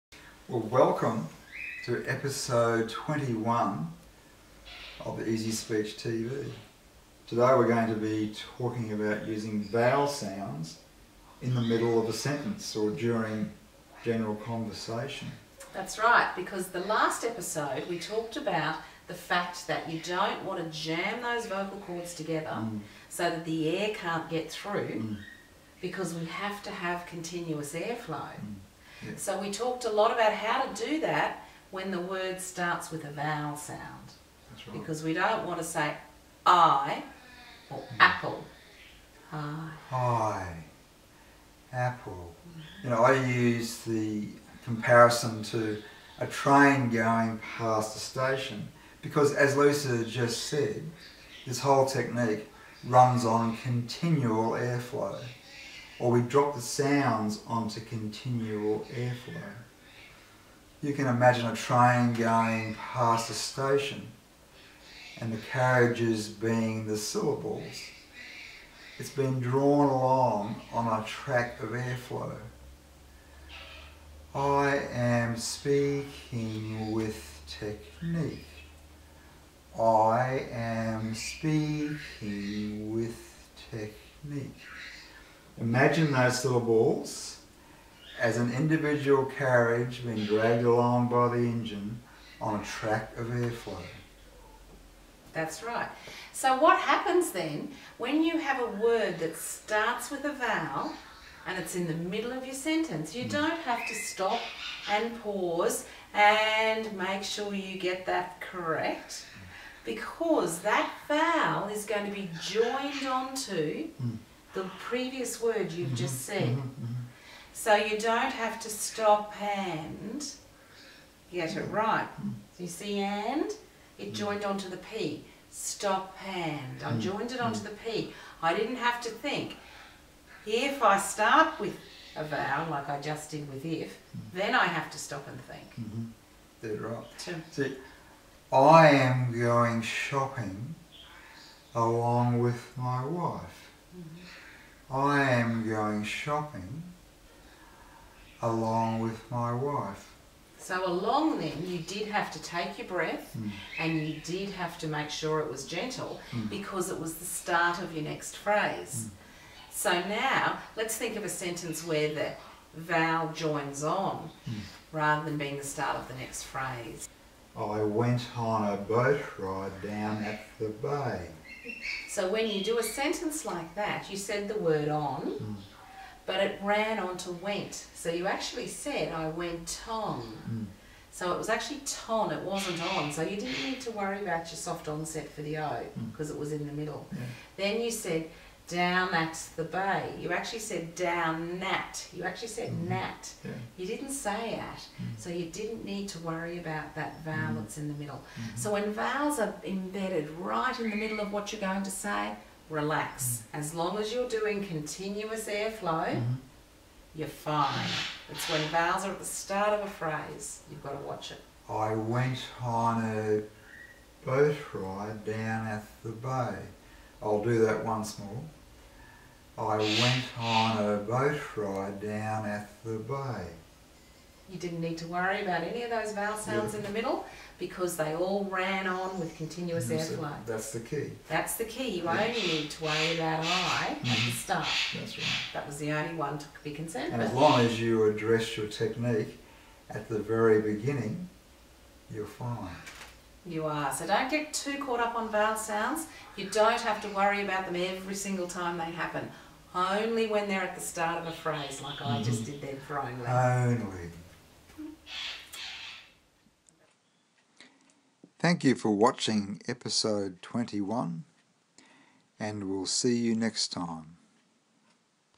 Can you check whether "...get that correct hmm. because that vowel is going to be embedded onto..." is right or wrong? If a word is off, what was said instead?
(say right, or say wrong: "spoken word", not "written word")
wrong: "joined", not "embedded".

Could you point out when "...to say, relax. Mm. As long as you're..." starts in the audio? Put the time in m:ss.
3:21.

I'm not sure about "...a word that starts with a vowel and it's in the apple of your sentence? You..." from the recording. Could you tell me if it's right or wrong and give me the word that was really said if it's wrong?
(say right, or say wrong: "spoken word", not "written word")
wrong: "middle", not "apple".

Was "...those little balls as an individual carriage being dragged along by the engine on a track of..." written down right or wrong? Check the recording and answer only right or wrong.
right.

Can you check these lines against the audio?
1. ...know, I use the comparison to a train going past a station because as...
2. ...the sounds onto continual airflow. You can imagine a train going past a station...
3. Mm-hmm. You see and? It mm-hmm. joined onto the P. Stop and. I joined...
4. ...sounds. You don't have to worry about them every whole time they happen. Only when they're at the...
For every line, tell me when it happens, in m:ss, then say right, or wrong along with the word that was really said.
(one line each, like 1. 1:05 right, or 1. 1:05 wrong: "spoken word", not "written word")
1. 0:42 right
2. 0:56 right
3. 2:02 right
4. 4:05 wrong: "single", not "whole".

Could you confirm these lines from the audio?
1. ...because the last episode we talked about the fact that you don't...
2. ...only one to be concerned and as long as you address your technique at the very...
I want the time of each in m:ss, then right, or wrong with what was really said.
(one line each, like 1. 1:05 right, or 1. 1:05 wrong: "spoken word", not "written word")
1. 0:16 right
2. 3:55 right.